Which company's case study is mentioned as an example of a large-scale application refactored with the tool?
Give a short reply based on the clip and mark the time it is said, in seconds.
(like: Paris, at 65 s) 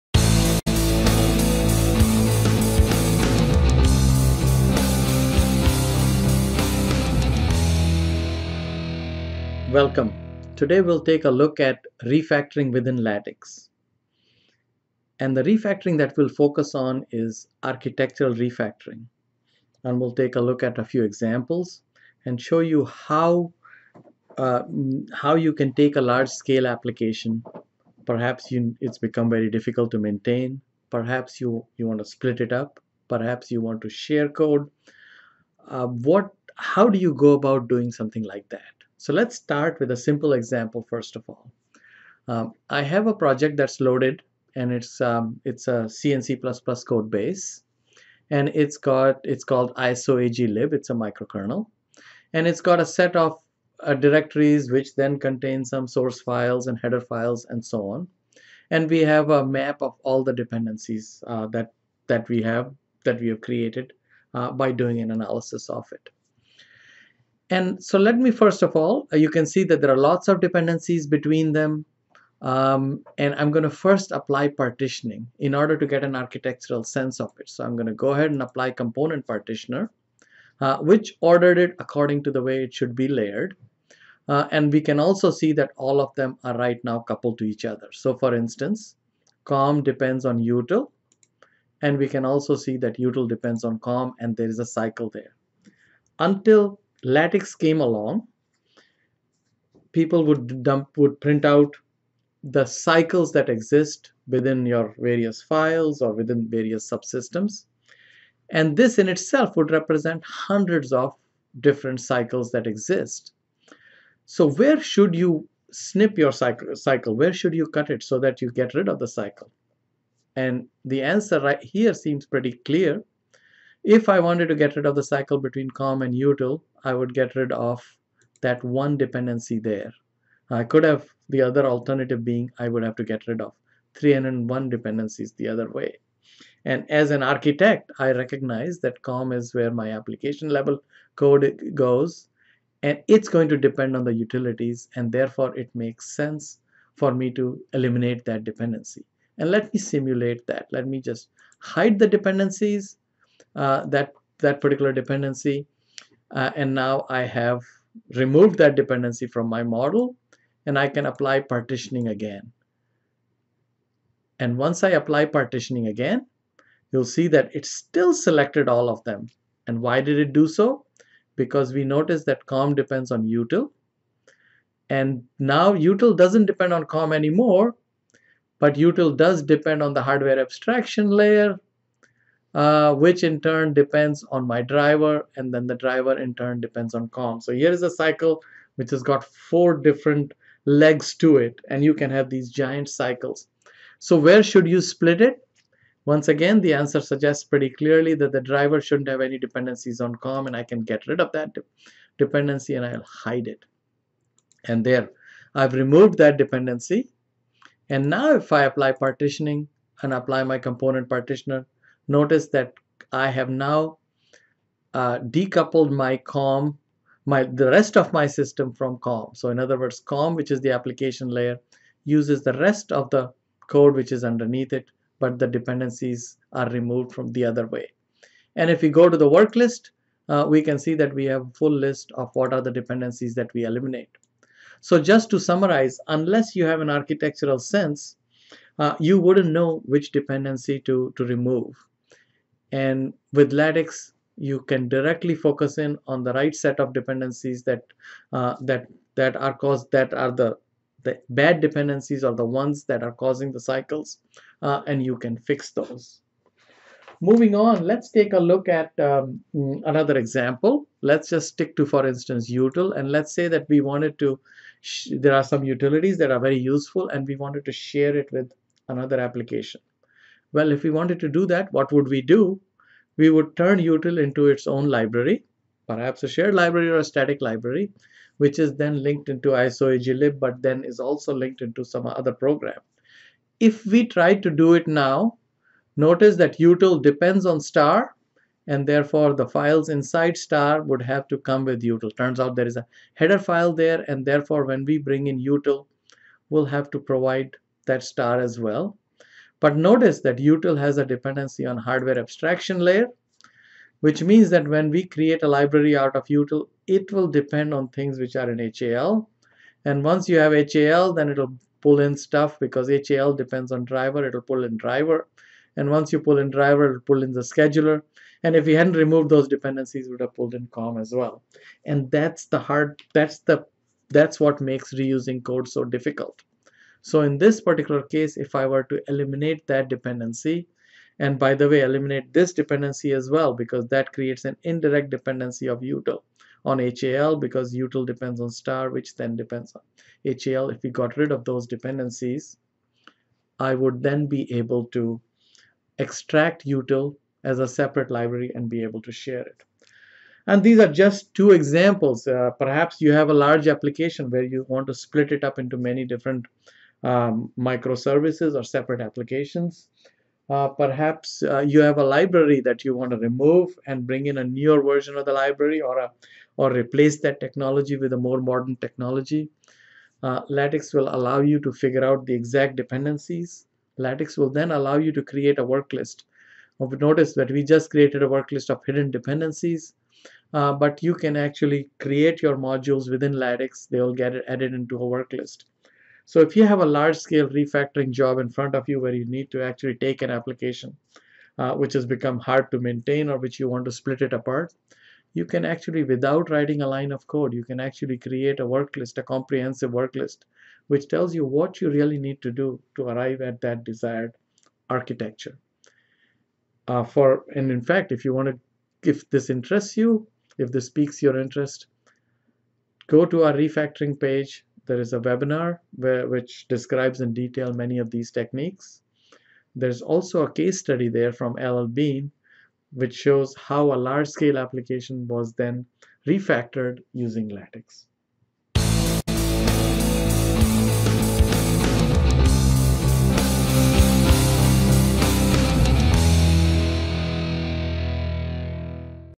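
LL Bean, at 421 s.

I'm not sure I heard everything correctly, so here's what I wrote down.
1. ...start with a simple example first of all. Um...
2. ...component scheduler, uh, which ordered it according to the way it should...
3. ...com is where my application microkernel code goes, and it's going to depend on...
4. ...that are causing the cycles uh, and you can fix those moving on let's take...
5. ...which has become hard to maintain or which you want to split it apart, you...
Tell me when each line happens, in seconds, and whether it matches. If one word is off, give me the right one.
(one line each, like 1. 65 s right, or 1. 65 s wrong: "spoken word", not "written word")
1. 39 s right
2. 78 s wrong: "partitioner", not "scheduler"
3. 139 s wrong: "level", not "microkernel"
4. 252 s right
5. 391 s right.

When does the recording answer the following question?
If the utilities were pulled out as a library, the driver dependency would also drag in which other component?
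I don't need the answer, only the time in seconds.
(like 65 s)
317 s.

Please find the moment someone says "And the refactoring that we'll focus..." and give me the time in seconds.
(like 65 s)
15 s.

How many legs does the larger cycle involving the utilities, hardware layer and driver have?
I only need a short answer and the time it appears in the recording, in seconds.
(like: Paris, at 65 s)
4, at 189 s.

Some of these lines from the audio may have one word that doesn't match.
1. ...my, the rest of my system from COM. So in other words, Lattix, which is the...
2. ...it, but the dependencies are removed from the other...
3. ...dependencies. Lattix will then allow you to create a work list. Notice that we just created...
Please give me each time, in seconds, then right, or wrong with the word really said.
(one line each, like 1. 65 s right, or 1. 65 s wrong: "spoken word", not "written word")
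1. 217 s wrong: "COM", not "Lattix"
2. 224 s right
3. 372 s right.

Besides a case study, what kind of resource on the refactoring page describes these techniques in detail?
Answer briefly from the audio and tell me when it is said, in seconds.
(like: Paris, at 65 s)
a webinar, at 415 s.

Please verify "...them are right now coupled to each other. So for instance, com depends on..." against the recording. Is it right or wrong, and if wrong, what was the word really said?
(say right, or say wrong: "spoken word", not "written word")
right.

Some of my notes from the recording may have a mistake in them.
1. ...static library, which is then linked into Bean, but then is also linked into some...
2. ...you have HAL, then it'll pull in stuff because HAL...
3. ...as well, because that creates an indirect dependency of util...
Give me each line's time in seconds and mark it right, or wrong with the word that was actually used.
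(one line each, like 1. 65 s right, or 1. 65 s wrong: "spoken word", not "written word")
1. 277 s wrong: "ISOAgLib", not "Bean"
2. 310 s right
3. 333 s right.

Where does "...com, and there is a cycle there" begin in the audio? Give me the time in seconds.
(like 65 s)
93 s.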